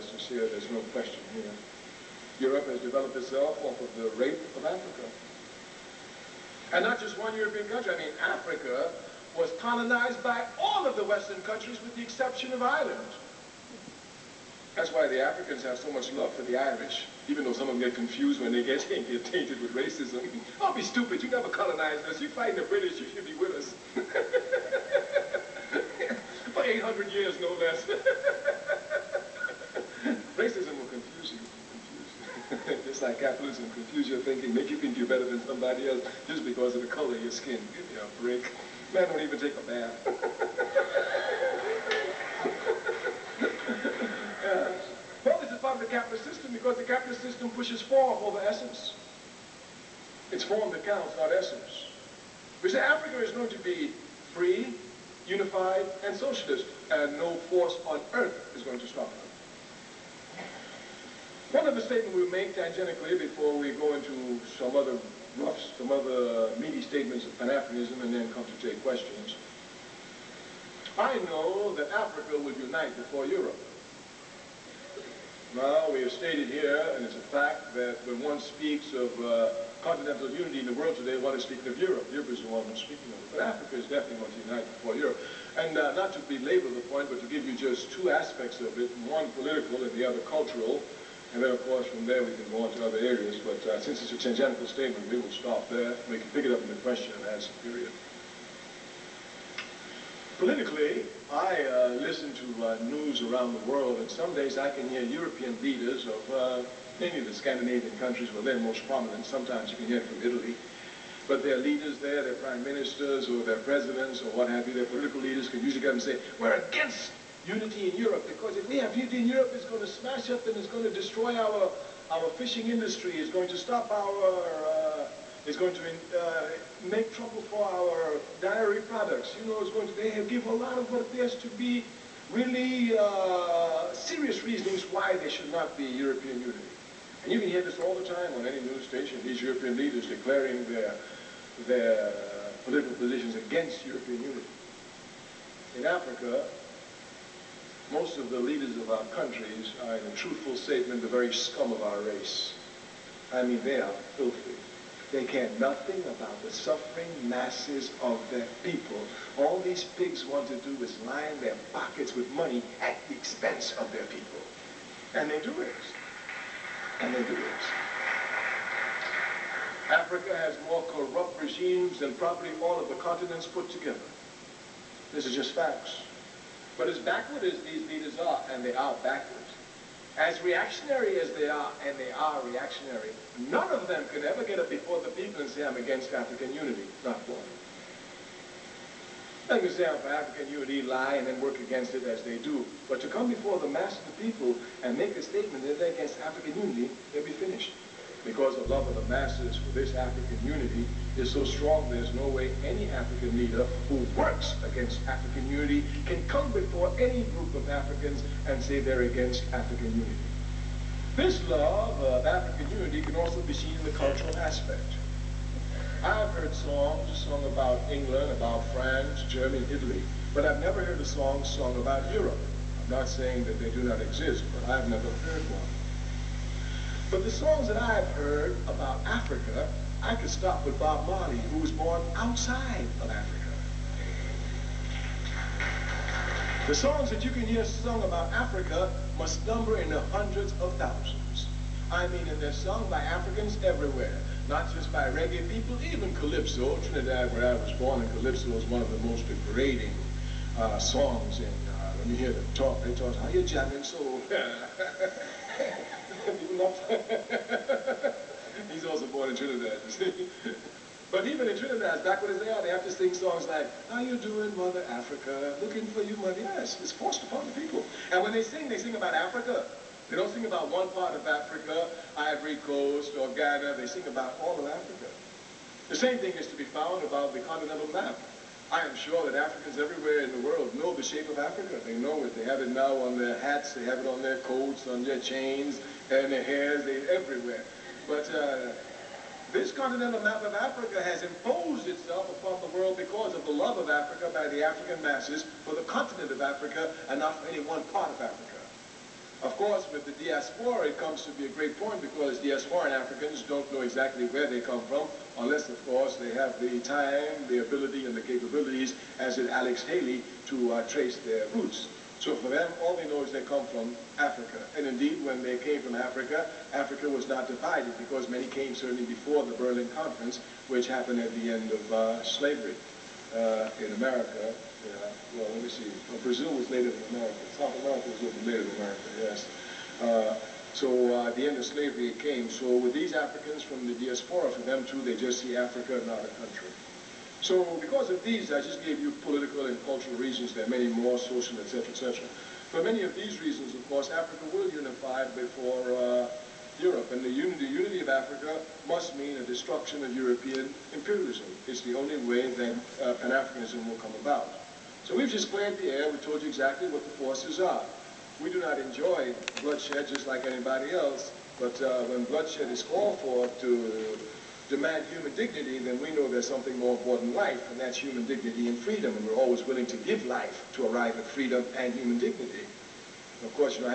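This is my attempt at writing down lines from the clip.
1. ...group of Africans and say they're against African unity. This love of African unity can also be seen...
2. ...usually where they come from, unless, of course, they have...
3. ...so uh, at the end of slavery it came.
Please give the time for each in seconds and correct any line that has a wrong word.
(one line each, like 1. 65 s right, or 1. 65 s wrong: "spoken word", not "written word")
1. 207 s right
2. 303 s wrong: "exactly", not "usually"
3. 330 s right.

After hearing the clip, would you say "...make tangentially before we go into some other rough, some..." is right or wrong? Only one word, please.
right.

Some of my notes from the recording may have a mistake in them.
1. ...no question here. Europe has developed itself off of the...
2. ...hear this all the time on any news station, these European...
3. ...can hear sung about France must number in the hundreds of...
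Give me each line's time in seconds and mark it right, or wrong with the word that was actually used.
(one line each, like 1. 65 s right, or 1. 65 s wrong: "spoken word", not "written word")
1. 0 s right
2. 137 s right
3. 237 s wrong: "Africa", not "France".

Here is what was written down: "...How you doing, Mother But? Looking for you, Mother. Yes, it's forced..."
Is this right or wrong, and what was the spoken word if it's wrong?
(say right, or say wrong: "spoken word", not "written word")
wrong: "Africa", not "But".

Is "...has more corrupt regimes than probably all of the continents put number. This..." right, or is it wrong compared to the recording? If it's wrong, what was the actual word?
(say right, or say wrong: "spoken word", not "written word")
wrong: "together", not "number".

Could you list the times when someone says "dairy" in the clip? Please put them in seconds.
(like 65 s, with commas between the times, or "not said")
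128 s.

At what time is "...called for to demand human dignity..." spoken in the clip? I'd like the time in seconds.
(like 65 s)
362 s.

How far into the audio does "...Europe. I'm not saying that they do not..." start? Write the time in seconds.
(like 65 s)
222 s.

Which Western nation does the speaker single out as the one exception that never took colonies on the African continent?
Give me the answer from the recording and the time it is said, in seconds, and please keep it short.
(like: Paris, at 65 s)
Ireland, at 12 s.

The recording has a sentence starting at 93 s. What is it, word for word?
But uh, since it's a tangential statement, we will stop there.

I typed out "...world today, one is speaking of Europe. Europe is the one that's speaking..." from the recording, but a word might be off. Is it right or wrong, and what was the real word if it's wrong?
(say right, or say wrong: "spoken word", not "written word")
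right.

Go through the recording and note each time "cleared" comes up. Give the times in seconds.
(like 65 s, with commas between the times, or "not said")
355 s.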